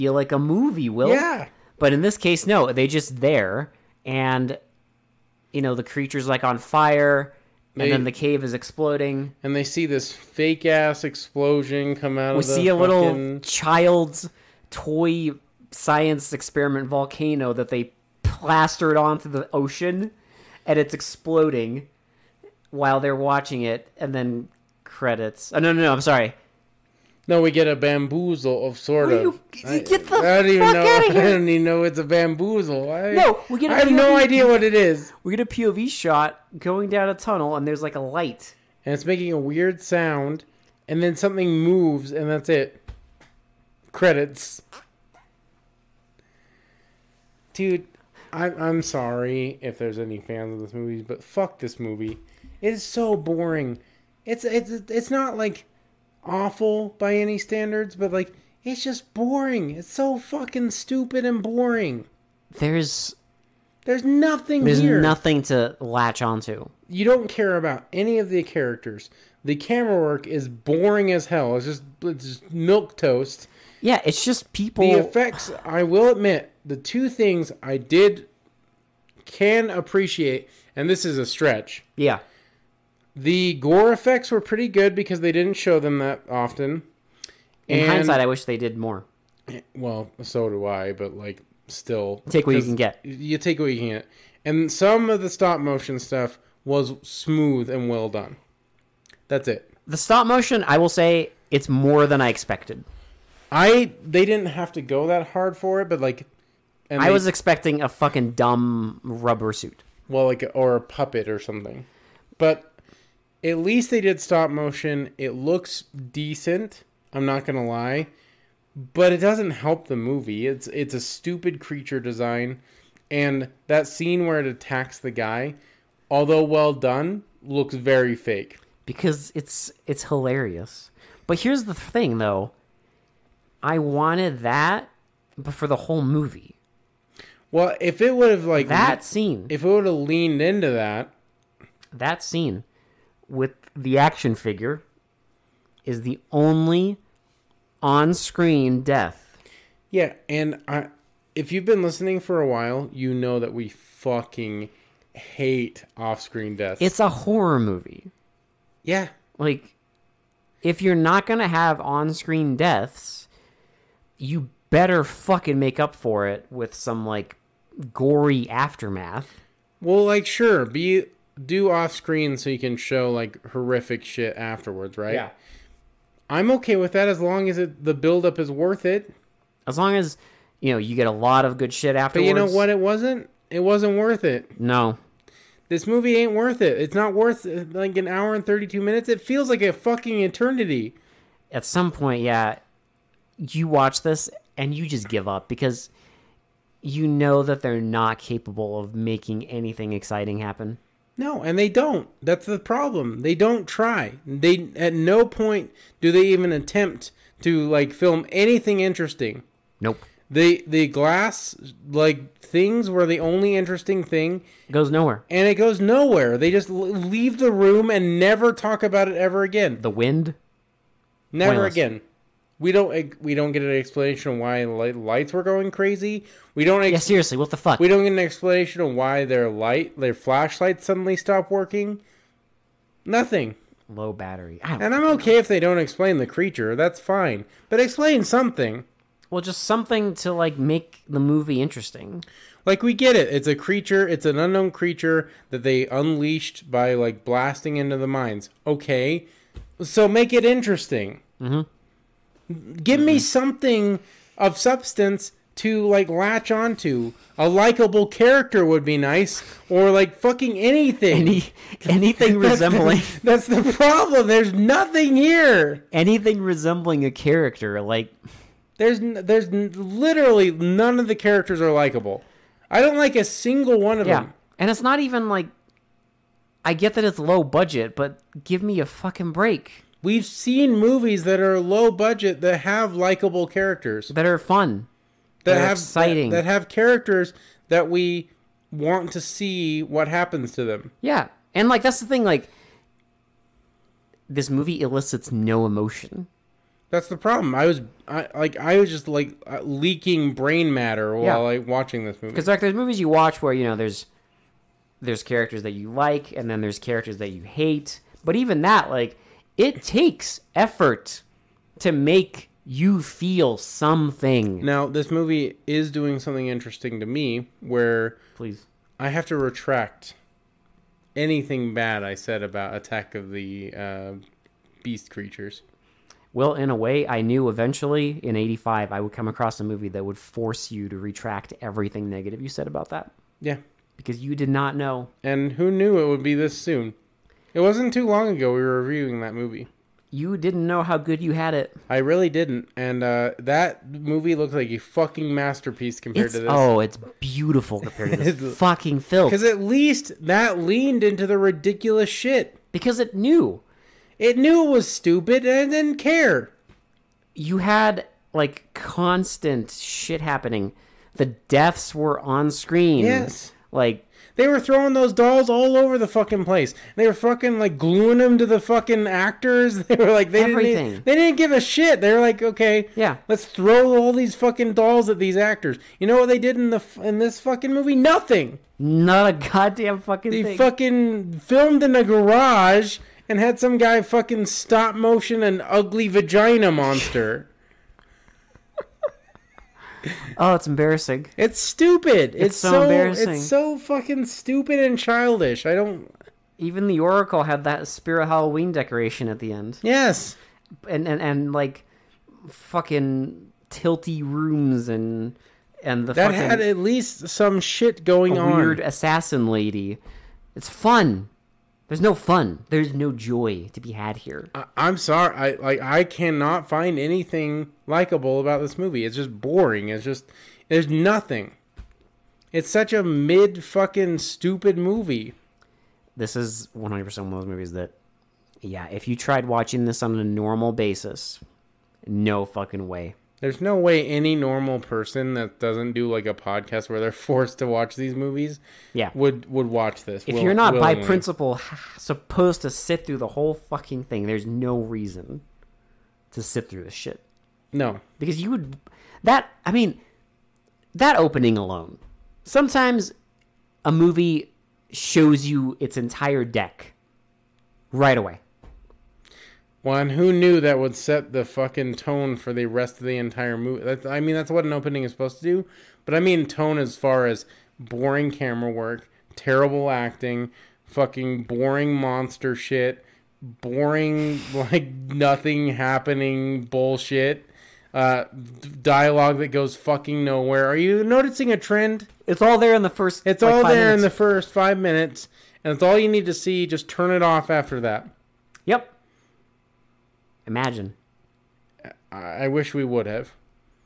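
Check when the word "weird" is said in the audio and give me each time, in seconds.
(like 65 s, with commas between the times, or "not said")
39 s, 408 s.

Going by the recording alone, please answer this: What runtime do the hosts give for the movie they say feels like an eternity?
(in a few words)
1 hour 32 minutes.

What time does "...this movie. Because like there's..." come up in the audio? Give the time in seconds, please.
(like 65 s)
302 s.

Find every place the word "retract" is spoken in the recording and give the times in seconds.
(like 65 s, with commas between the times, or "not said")
319 s, 330 s.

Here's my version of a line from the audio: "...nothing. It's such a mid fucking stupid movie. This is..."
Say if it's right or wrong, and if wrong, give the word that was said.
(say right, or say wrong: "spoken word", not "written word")
right.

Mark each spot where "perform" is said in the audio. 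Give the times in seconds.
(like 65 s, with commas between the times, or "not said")
not said.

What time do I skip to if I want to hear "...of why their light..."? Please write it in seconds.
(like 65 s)
228 s.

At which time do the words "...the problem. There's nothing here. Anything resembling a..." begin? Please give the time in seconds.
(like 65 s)
263 s.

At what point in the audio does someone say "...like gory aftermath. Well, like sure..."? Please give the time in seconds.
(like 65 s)
167 s.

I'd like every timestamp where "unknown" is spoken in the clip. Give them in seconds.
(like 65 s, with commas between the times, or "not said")
244 s.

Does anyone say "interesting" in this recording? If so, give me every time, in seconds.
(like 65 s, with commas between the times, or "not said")
208 s, 213 s, 241 s, 250 s, 316 s.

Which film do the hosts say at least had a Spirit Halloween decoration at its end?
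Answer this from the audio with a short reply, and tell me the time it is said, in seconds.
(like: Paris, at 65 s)
The Oracle, at 396 s.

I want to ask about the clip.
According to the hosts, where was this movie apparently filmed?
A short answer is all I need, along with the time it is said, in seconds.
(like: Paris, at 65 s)
a garage, at 382 s.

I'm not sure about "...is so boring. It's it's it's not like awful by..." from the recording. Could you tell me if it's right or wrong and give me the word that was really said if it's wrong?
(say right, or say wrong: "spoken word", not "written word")
right.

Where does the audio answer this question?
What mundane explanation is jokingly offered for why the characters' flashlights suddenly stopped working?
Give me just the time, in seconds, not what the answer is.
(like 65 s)
233 s.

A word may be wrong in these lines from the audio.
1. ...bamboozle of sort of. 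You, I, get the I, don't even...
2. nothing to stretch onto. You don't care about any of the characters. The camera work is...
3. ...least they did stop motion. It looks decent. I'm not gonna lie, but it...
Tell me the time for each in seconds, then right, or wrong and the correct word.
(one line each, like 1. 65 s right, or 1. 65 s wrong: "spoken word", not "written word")
1. 27 s right
2. 65 s wrong: "latch", not "stretch"
3. 113 s right.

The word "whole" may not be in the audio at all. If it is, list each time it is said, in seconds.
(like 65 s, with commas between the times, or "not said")
135 s, 443 s.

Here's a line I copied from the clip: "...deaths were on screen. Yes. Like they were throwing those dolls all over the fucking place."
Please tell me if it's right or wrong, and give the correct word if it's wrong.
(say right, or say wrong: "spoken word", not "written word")
right.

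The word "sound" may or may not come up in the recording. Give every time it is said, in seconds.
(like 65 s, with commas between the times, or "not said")
39 s.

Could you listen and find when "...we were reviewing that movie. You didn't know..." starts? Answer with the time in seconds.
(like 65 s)
338 s.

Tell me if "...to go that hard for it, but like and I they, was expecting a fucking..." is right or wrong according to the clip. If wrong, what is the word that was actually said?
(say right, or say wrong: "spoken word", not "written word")
right.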